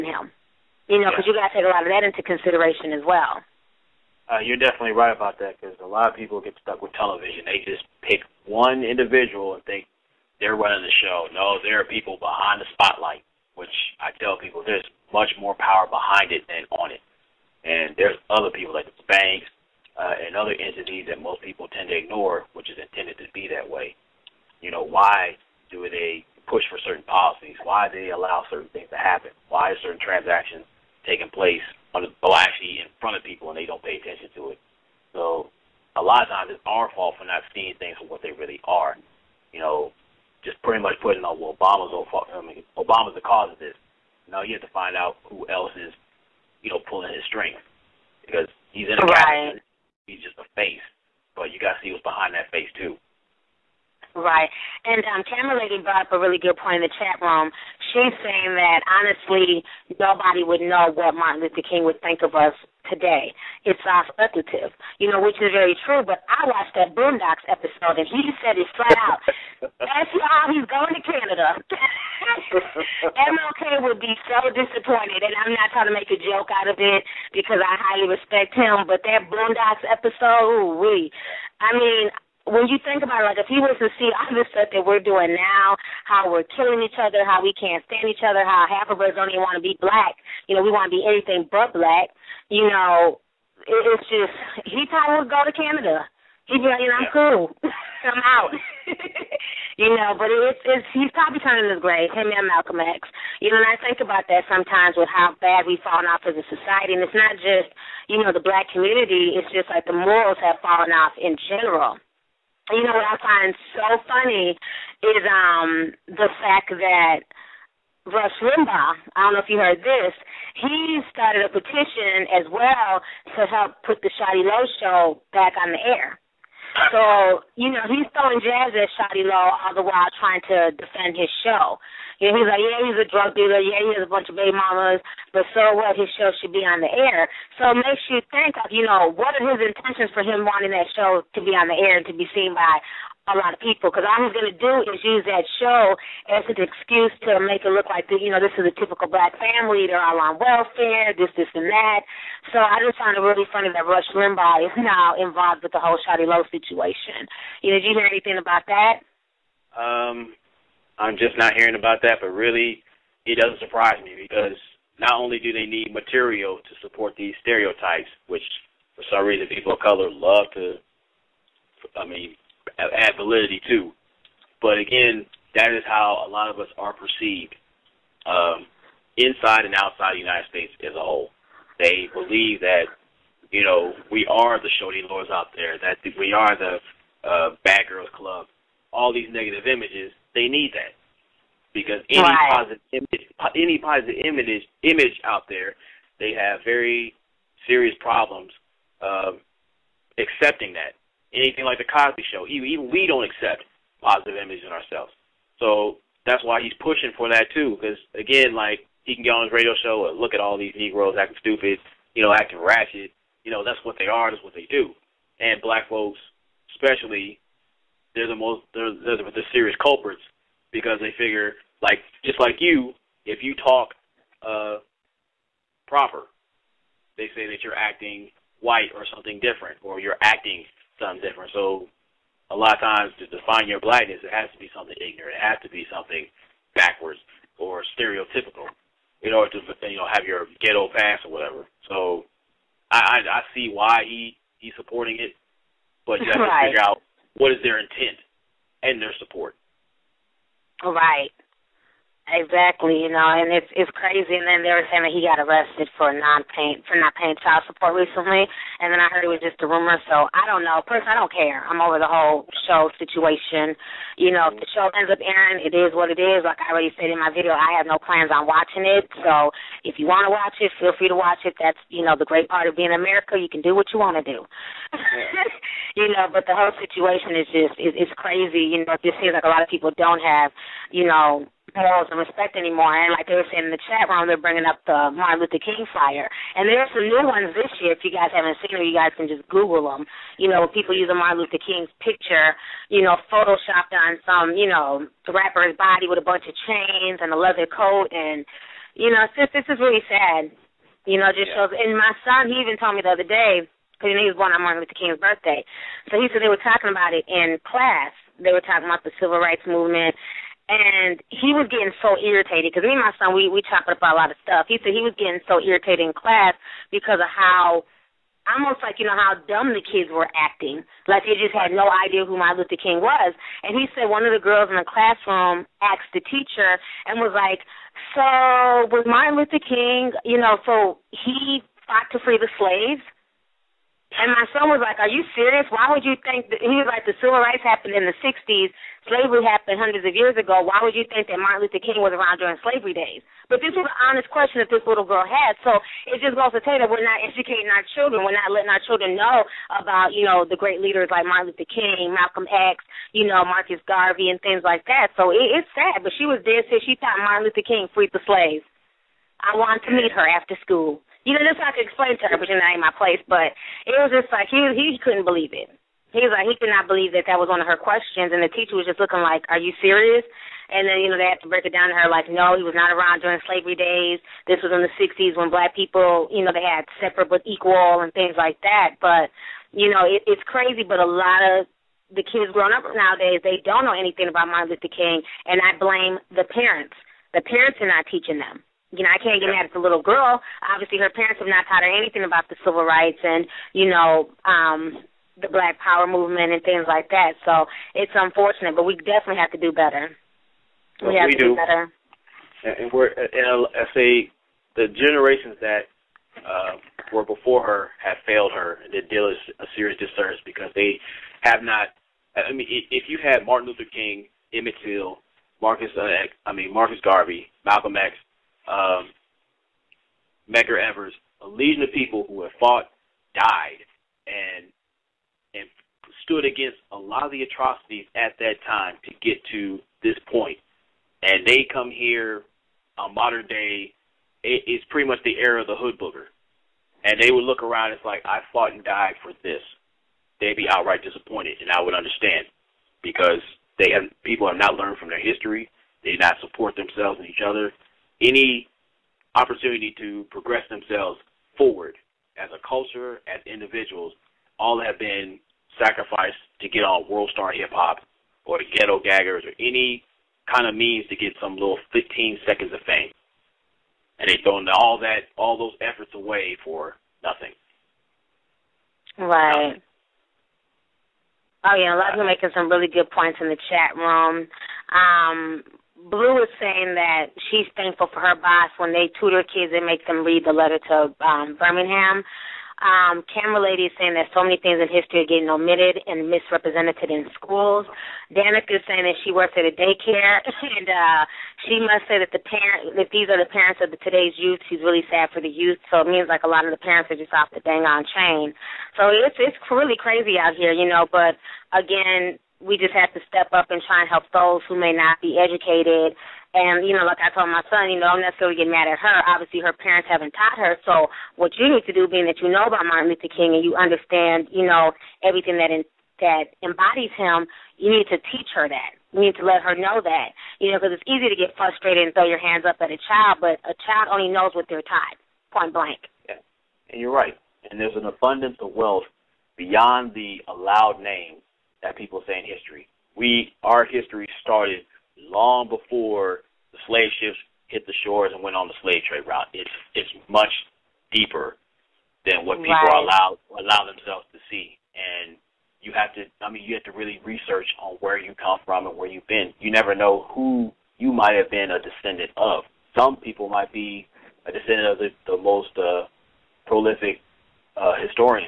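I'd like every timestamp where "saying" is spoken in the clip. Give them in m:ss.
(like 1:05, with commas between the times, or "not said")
0:58, 4:14, 4:43, 7:56, 8:03, 8:08.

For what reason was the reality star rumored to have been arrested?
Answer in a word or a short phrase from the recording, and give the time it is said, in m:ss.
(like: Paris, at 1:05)
Not paying child support, at 4:17.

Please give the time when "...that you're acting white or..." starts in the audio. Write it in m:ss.
3:47.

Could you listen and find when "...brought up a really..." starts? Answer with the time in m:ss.
0:55.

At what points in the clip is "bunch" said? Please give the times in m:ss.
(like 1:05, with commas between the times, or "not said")
2:14, 4:56.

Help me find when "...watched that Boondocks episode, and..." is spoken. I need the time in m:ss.
1:06.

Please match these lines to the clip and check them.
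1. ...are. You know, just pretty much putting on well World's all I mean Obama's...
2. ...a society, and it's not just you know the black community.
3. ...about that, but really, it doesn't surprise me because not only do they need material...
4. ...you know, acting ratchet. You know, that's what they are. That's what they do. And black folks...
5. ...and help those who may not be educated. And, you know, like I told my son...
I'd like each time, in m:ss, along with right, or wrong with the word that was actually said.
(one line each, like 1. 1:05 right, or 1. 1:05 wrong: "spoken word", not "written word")
1. 0:38 wrong: "Obama", not "World"
2. 1:46 right
3. 2:41 right
4. 3:32 right
5. 8:24 right.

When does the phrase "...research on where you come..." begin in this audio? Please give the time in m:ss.
9:07.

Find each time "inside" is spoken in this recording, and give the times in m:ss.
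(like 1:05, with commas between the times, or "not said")
2:59.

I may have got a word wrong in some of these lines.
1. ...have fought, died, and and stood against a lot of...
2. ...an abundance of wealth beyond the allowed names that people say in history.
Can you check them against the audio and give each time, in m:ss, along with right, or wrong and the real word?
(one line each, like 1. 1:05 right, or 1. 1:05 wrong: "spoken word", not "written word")
1. 7:02 right
2. 8:47 right.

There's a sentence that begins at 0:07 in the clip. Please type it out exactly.
They just pick one individual and think they're running the show.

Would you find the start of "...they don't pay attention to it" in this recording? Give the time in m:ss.
0:33.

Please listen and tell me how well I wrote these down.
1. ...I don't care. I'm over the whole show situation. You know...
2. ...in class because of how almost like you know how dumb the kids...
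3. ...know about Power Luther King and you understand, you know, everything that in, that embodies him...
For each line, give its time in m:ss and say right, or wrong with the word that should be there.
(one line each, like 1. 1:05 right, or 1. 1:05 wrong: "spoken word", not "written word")
1. 4:21 right
2. 5:16 right
3. 8:32 wrong: "Martin", not "Power".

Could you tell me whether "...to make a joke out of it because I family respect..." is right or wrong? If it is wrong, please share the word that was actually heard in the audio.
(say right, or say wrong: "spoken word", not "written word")
wrong: "highly", not "family".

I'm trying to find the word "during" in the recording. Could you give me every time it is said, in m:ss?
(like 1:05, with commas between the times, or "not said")
5:42, 6:13.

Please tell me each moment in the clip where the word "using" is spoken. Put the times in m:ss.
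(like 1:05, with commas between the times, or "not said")
4:50.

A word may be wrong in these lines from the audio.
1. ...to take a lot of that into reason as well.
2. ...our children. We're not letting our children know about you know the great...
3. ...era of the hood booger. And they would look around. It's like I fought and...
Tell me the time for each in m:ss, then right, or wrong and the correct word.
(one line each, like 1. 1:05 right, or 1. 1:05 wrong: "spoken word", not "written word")
1. 0:01 wrong: "consideration", not "reason"
2. 5:47 right
3. 7:15 right.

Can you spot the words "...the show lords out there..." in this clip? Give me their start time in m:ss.
3:04.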